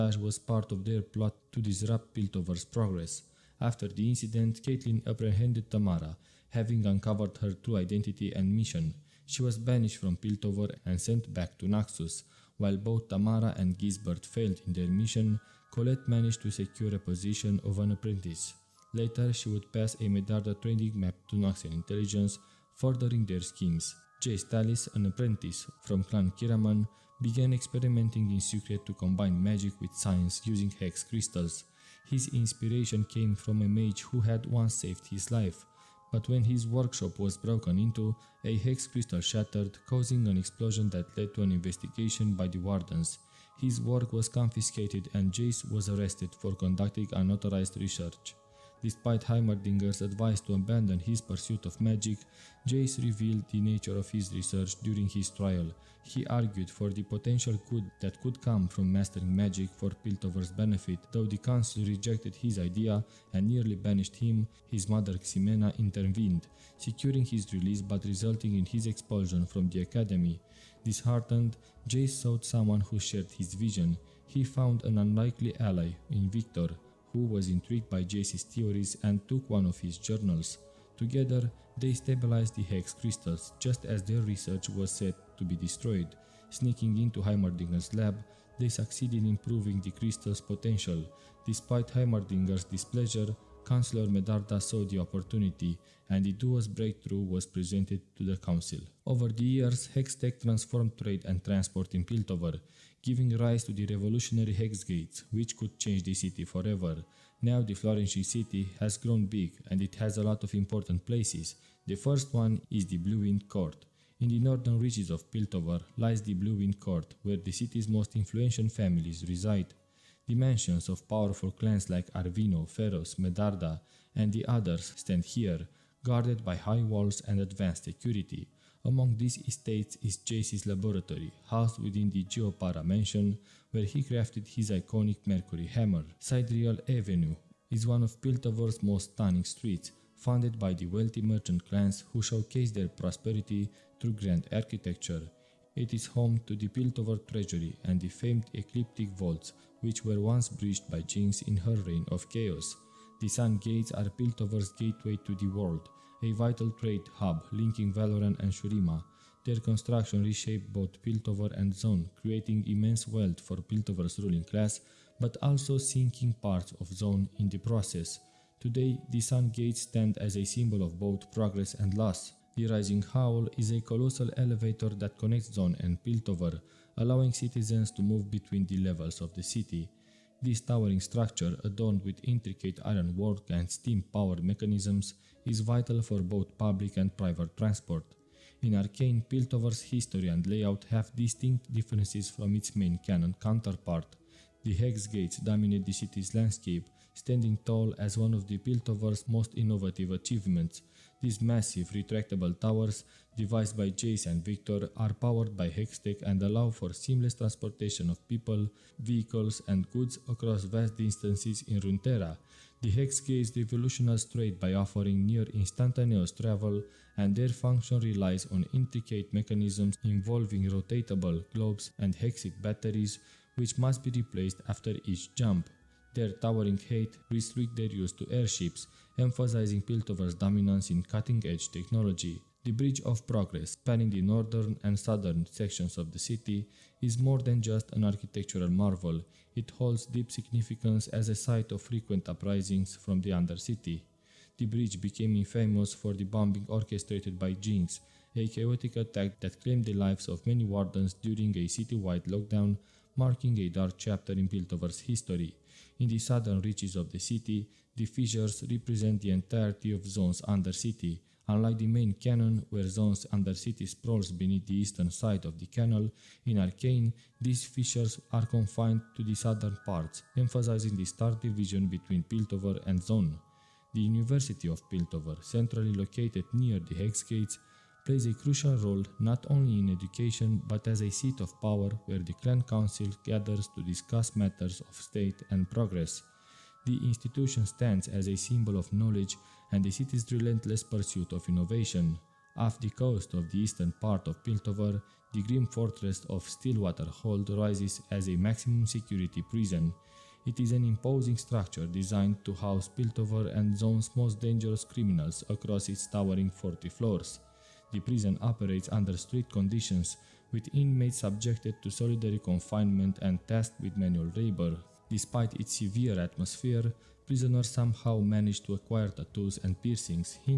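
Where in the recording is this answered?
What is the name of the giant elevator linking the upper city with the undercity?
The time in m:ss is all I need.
2:52.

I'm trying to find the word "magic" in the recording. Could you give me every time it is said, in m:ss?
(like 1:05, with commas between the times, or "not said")
0:29, 0:51, 0:59.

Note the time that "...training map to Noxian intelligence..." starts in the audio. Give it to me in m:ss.
0:20.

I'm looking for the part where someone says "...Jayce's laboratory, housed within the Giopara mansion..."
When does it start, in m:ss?
2:10.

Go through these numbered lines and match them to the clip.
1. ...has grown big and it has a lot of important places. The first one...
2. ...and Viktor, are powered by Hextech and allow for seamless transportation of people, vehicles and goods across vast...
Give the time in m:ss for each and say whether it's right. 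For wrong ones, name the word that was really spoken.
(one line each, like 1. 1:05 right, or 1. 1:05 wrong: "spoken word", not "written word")
1. 1:48 right
2. 3:24 right.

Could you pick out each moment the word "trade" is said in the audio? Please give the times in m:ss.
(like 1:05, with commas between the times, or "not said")
1:40, 2:36, 3:34.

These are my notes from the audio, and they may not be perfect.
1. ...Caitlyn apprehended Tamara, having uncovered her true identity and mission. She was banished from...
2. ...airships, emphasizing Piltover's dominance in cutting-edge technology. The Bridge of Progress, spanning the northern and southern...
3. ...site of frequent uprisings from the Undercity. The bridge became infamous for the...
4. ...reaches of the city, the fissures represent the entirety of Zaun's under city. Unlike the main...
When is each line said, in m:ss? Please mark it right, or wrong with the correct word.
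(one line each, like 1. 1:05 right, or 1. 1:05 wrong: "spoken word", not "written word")
1. 0:04 right
2. 3:48 right
3. 4:01 right
4. 4:16 right.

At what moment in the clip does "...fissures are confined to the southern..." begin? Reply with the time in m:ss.
4:27.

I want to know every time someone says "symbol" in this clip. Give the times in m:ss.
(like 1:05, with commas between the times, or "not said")
2:50, 4:48.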